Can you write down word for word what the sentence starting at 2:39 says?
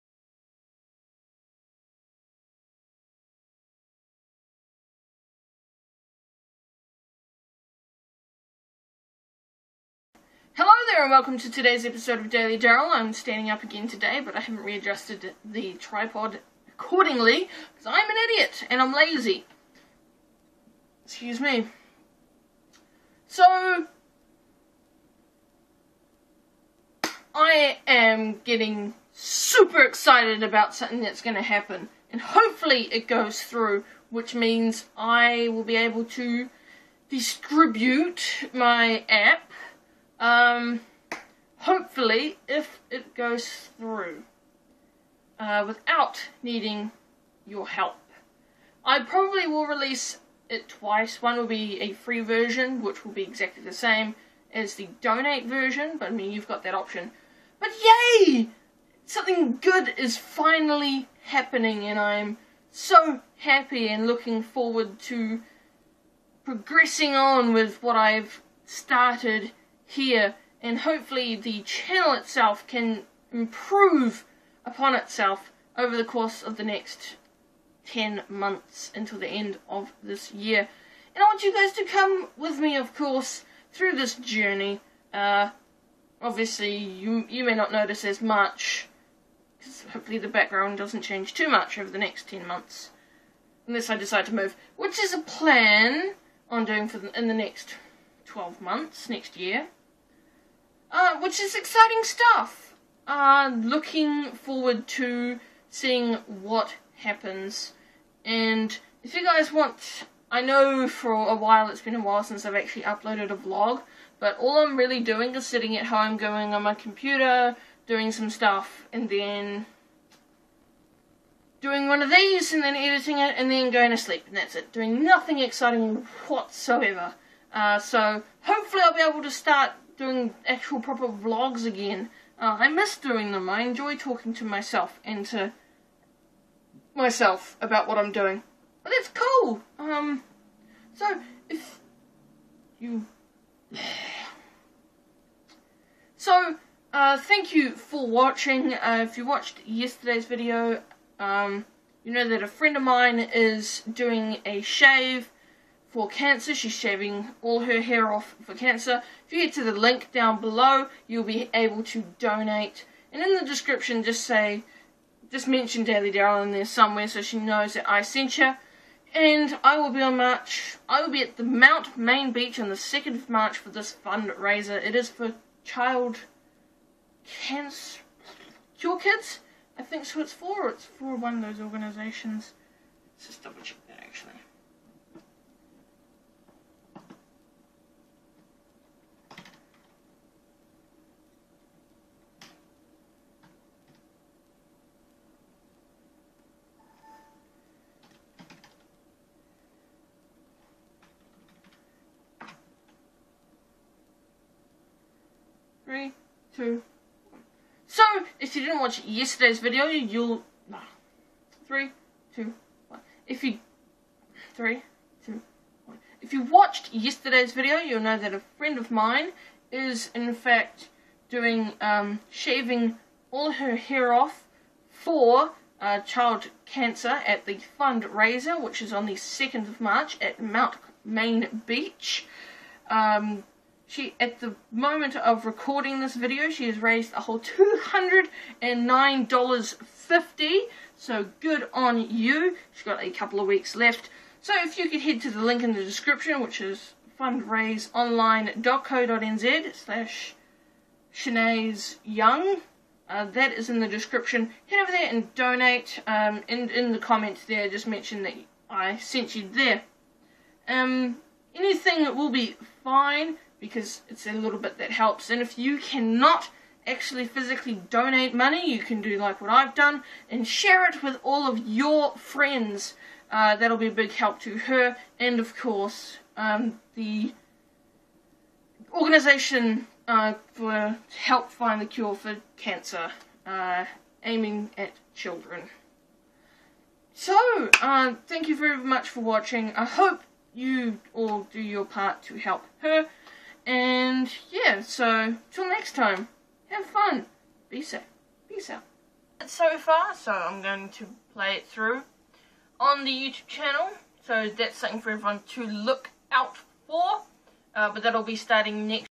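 If you get to the link down below, you'll be able to donate.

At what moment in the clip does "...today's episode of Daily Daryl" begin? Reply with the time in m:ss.
0:11.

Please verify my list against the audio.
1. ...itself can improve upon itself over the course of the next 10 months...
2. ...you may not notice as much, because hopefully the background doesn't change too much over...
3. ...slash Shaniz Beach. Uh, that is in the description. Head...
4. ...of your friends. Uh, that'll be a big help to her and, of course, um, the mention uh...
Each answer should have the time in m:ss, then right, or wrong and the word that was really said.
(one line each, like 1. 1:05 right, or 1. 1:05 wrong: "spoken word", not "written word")
1. 1:12 right
2. 1:27 right
3. 4:09 wrong: "Young", not "Beach"
4. 4:31 wrong: "organization", not "mention".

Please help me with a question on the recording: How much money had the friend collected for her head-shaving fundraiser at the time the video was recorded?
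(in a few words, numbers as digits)
$209.50.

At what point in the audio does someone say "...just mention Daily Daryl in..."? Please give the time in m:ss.
2:45.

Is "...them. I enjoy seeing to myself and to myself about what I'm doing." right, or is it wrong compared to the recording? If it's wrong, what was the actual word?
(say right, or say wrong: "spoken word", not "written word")
wrong: "talking", not "seeing".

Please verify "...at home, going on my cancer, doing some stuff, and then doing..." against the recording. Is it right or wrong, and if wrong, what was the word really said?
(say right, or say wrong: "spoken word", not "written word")
wrong: "computer", not "cancer".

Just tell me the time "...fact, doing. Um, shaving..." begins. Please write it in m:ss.
3:40.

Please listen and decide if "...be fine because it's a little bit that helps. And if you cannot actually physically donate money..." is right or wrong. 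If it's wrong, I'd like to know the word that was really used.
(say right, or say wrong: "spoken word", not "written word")
right.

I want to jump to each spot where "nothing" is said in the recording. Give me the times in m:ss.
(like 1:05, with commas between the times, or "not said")
2:05.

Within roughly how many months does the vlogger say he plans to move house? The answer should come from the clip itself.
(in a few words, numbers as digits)
12.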